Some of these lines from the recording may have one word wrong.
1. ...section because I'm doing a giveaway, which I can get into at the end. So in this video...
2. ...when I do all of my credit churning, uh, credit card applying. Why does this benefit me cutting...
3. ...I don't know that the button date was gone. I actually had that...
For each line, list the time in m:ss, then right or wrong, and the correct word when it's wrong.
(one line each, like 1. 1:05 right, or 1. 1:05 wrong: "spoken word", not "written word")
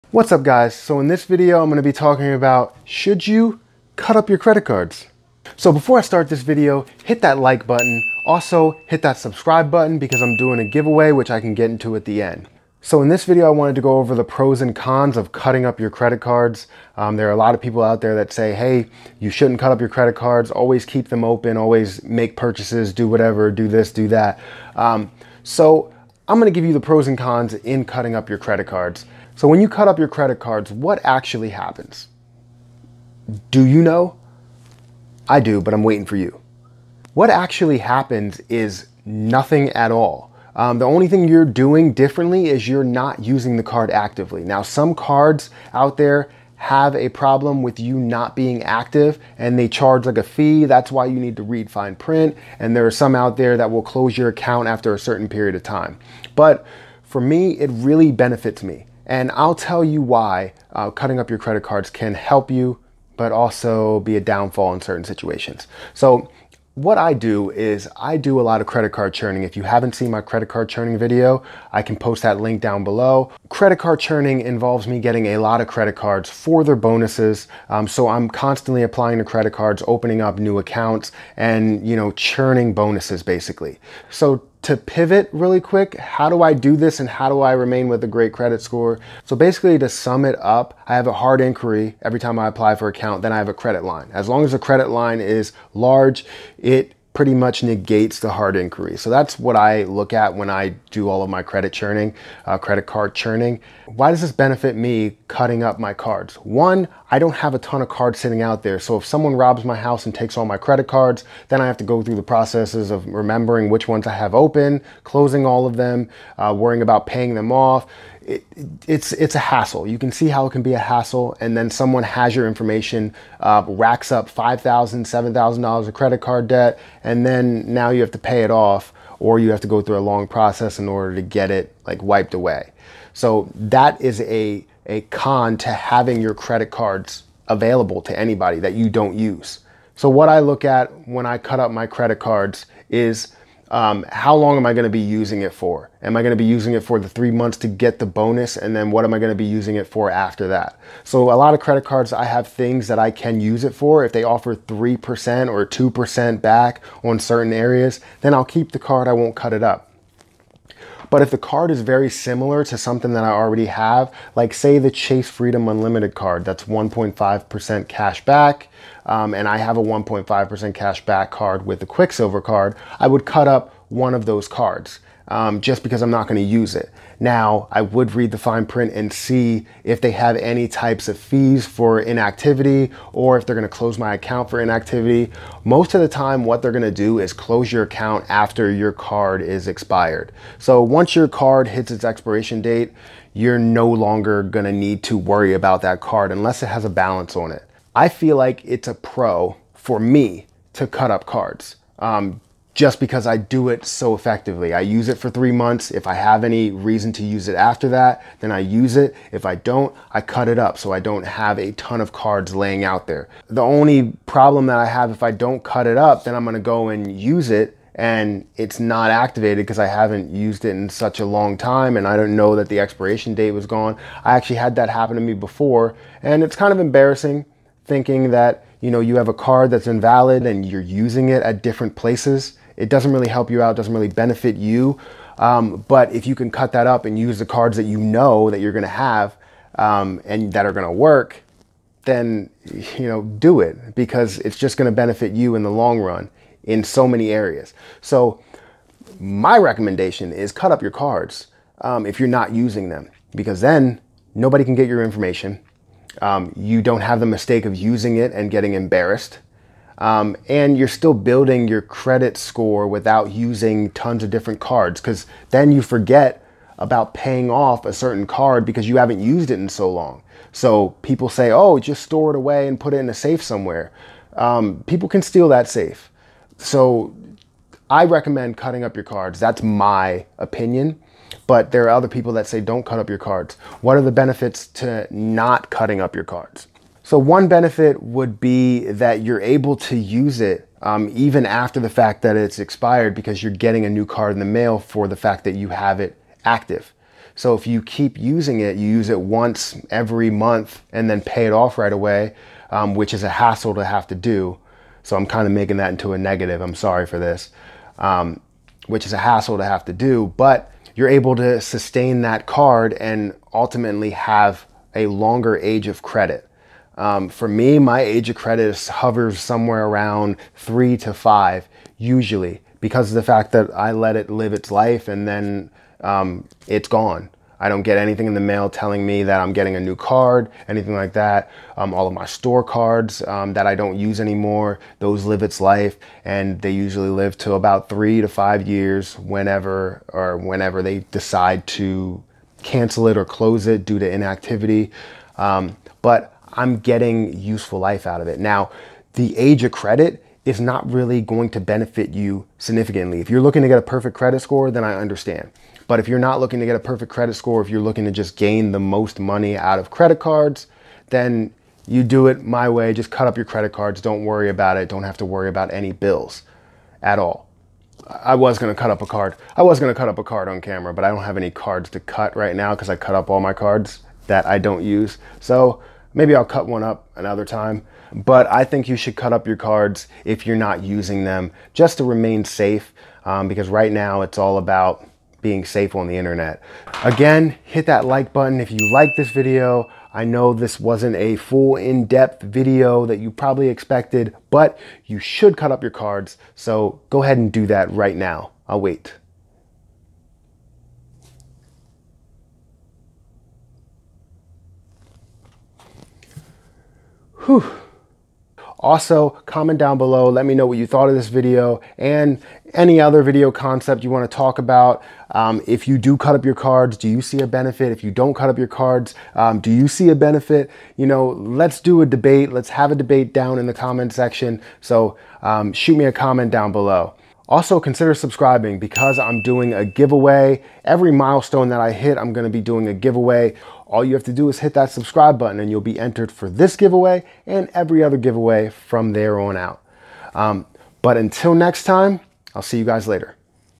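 1. 0:09 wrong: "button", not "section"
2. 1:40 wrong: "churning", not "applying"
3. 3:42 wrong: "expiration", not "button".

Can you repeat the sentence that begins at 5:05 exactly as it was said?
So I'm kind of making that into a negative.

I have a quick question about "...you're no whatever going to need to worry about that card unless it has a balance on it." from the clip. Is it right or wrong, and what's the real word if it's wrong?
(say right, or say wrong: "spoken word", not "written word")
wrong: "longer", not "whatever".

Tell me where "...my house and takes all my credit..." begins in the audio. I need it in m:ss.
1:49.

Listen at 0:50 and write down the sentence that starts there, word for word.
That's why you need to read fine print.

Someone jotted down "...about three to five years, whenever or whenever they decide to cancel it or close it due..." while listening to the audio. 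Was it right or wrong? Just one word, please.
right.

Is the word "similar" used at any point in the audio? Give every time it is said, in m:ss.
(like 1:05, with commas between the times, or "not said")
2:42.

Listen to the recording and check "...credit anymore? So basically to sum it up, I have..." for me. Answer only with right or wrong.
wrong.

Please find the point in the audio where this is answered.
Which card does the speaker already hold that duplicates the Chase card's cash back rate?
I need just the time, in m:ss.
2:51.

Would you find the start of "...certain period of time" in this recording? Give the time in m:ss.
0:54.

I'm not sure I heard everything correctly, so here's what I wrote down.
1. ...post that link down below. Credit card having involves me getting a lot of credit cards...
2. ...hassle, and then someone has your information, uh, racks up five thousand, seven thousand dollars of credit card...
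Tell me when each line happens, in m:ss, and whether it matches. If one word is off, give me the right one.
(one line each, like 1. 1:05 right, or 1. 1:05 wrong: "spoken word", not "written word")
1. 1:11 wrong: "churning", not "having"
2. 2:00 right.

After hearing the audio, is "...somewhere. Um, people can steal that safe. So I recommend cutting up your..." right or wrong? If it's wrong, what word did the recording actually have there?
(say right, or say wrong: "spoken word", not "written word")
right.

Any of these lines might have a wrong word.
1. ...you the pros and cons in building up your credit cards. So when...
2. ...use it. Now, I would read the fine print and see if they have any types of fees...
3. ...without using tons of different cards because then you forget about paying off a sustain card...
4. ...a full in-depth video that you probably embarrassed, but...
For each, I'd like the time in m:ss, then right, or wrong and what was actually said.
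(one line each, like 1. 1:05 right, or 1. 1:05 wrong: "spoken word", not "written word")
1. 0:26 wrong: "cutting", not "building"
2. 2:56 right
3. 4:22 wrong: "certain", not "sustain"
4. 6:31 wrong: "expected", not "embarrassed".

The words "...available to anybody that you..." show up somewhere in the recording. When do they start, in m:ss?
2:17.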